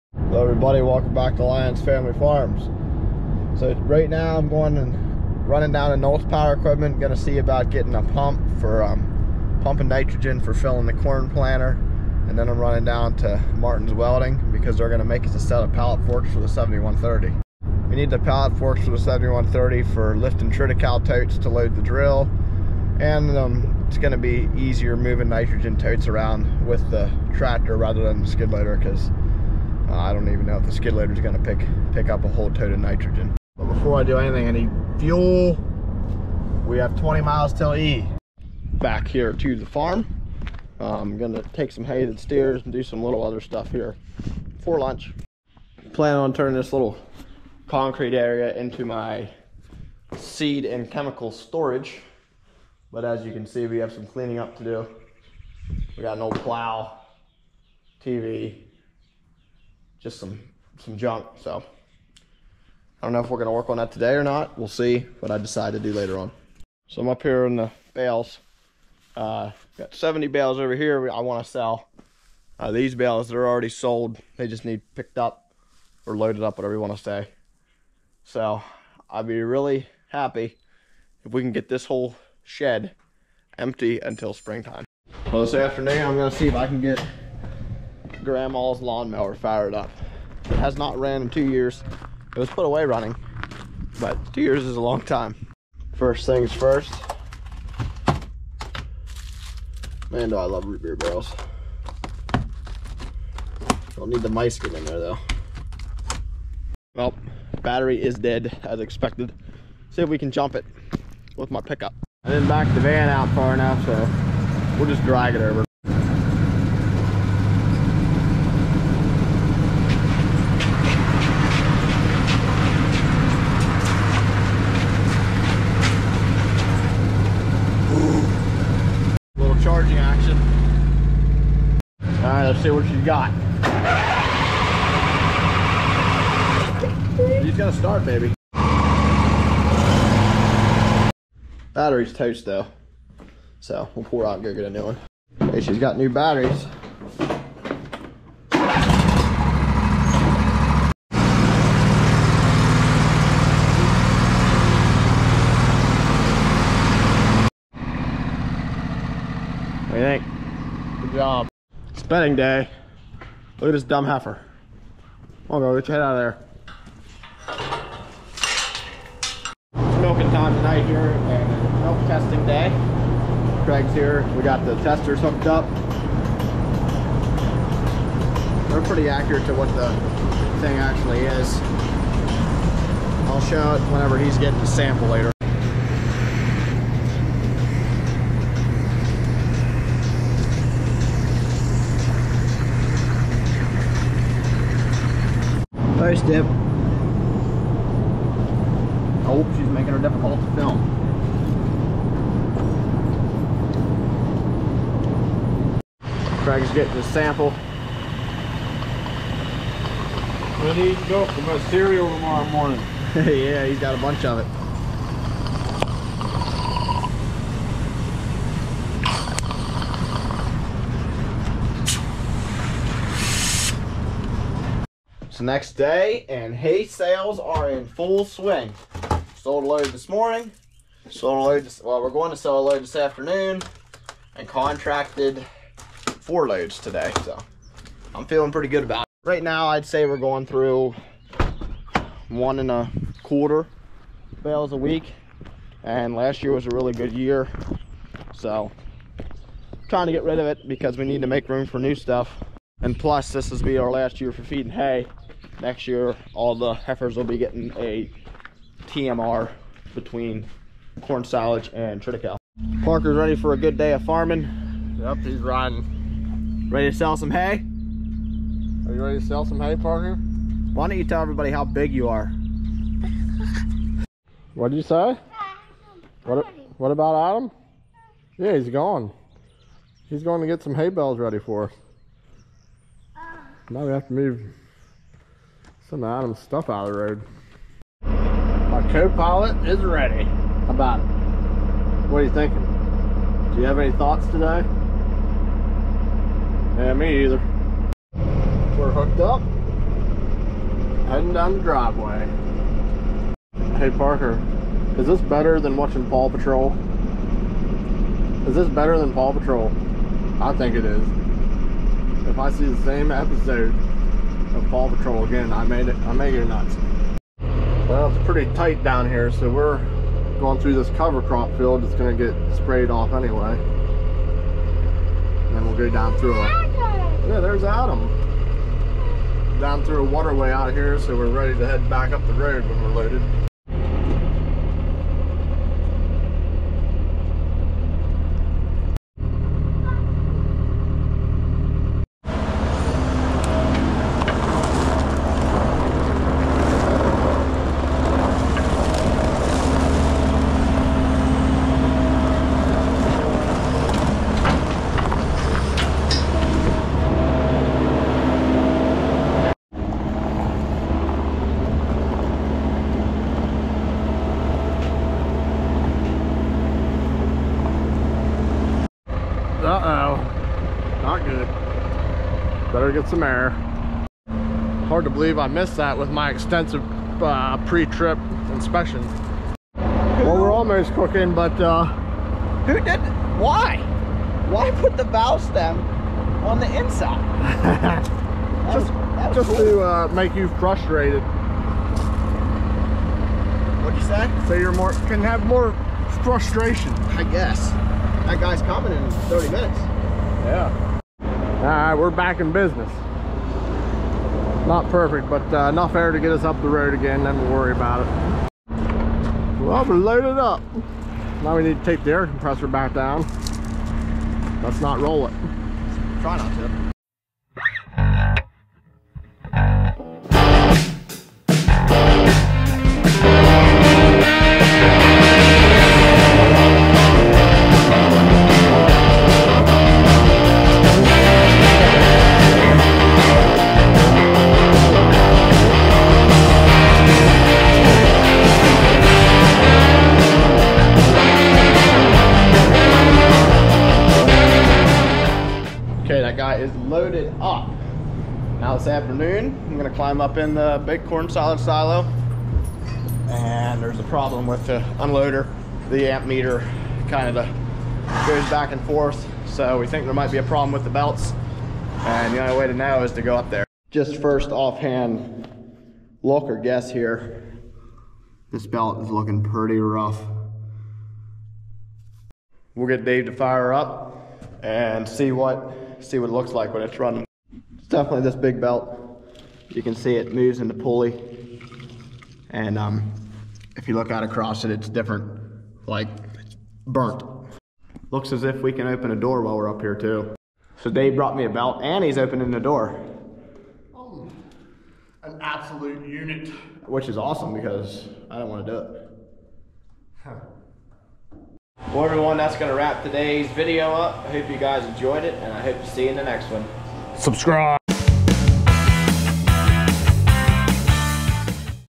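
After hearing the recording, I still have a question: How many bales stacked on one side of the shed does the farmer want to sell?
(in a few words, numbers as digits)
70.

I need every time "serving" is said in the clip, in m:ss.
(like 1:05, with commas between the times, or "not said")
not said.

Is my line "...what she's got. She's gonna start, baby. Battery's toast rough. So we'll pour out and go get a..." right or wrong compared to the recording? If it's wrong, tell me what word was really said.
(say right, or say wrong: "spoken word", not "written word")
wrong: "though", not "rough".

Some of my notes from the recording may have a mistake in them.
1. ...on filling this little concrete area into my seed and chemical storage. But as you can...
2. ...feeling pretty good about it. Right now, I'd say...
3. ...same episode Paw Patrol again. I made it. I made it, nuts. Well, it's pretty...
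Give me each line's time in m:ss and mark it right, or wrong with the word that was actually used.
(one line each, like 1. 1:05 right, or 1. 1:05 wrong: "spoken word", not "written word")
1. 0:46 wrong: "turning", not "filling"
2. 3:58 right
3. 5:12 right.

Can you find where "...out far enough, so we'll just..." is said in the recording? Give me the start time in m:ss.
1:53.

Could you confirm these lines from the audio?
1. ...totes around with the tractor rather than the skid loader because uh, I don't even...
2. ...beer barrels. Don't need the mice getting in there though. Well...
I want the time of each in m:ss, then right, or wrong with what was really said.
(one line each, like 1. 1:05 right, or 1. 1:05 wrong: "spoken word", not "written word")
1. 0:25 right
2. 1:40 right.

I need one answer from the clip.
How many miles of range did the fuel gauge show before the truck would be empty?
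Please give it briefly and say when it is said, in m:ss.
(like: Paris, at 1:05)
20, at 0:36.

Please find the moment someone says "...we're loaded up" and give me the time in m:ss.
6:49.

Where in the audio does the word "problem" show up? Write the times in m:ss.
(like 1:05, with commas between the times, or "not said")
7:34, 7:40.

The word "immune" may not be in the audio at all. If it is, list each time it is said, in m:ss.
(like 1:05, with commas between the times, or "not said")
not said.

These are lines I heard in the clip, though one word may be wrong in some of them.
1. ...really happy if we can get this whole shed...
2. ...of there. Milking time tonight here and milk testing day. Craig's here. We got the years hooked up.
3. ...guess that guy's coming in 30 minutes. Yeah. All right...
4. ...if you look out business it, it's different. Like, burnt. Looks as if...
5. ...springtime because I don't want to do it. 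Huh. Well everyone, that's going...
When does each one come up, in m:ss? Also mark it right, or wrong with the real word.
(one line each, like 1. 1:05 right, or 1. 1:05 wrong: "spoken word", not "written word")
1. 1:19 right
2. 2:47 wrong: "testers", not "years"
3. 6:37 right
4. 8:03 wrong: "across", not "business"
5. 8:17 wrong: "awesome", not "springtime".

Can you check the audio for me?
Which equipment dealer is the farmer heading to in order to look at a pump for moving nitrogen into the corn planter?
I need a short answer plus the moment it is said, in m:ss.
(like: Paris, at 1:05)
Knowles Power Equipment, at 0:05.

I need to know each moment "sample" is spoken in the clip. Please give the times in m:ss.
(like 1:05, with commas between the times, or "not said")
3:04, 3:27.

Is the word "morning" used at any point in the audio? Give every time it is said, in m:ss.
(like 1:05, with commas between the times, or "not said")
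3:32, 3:50.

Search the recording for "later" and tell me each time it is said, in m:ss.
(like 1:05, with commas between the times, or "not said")
1:05, 3:05.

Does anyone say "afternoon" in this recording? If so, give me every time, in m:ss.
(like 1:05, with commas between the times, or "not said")
1:25, 3:52, 7:28.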